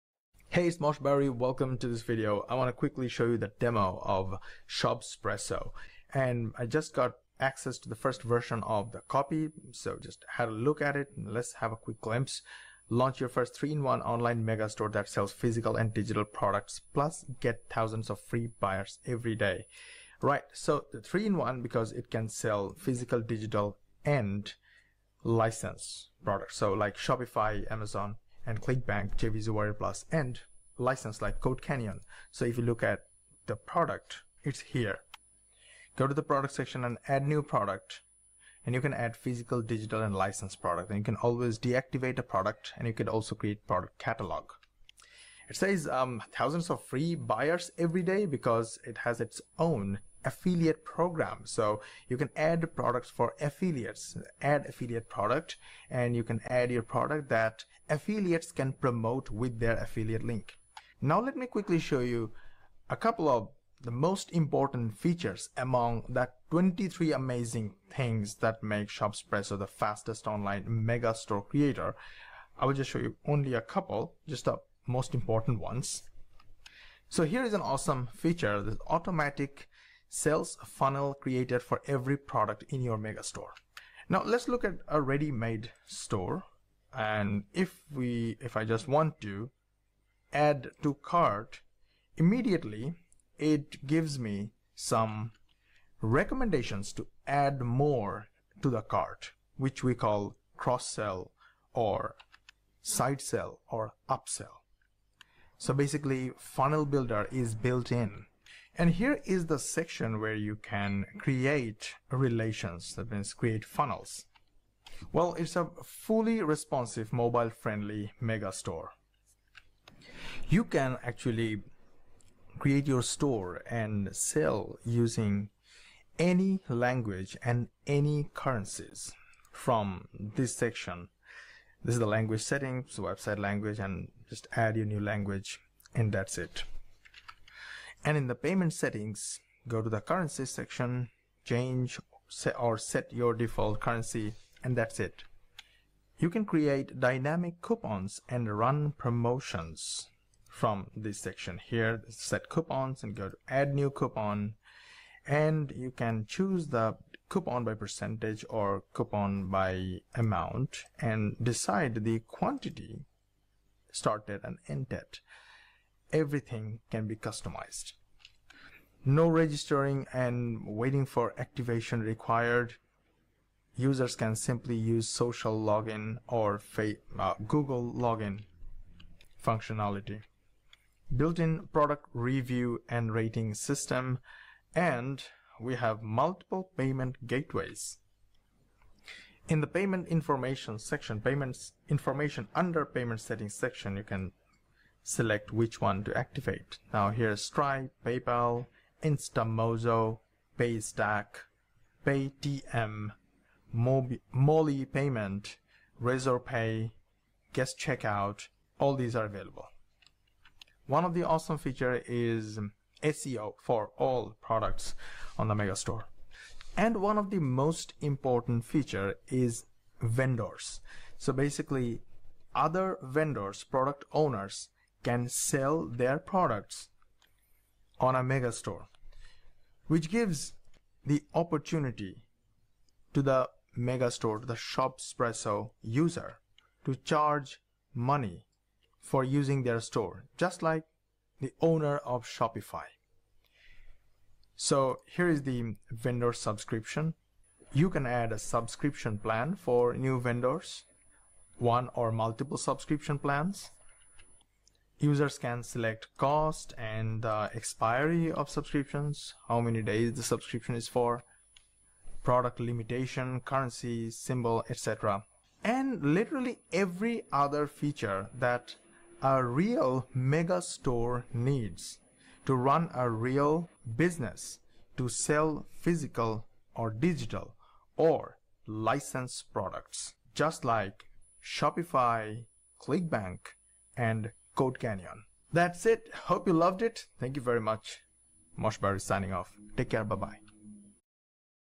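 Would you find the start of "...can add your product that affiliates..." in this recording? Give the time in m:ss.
0:56.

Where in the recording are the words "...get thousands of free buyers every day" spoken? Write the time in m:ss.
0:17.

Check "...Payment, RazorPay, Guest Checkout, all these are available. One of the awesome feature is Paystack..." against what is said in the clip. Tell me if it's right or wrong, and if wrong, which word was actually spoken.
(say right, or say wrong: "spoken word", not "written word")
wrong: "SEO", not "Paystack".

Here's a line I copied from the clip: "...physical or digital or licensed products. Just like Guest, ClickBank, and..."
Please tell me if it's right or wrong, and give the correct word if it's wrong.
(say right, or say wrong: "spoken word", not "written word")
wrong: "Shopify", not "Guest".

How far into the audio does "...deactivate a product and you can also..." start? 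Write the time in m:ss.
0:41.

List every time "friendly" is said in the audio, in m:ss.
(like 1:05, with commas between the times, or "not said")
1:57.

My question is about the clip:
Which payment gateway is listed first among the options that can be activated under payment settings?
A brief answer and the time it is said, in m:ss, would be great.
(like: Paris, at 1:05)
Stripe, at 3:17.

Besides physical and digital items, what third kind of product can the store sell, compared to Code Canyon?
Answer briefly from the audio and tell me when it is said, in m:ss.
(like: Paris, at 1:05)
License products, at 0:25.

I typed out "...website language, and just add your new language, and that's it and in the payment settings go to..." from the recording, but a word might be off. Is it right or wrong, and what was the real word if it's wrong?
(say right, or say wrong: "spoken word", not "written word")
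right.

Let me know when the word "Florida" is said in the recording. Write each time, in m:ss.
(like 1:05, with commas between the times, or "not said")
not said.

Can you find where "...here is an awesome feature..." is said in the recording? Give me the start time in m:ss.
1:17.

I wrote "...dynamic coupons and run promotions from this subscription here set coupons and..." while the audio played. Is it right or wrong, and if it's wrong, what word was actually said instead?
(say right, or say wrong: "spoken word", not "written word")
wrong: "section", not "subscription".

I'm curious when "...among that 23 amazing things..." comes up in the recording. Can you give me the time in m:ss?
1:05.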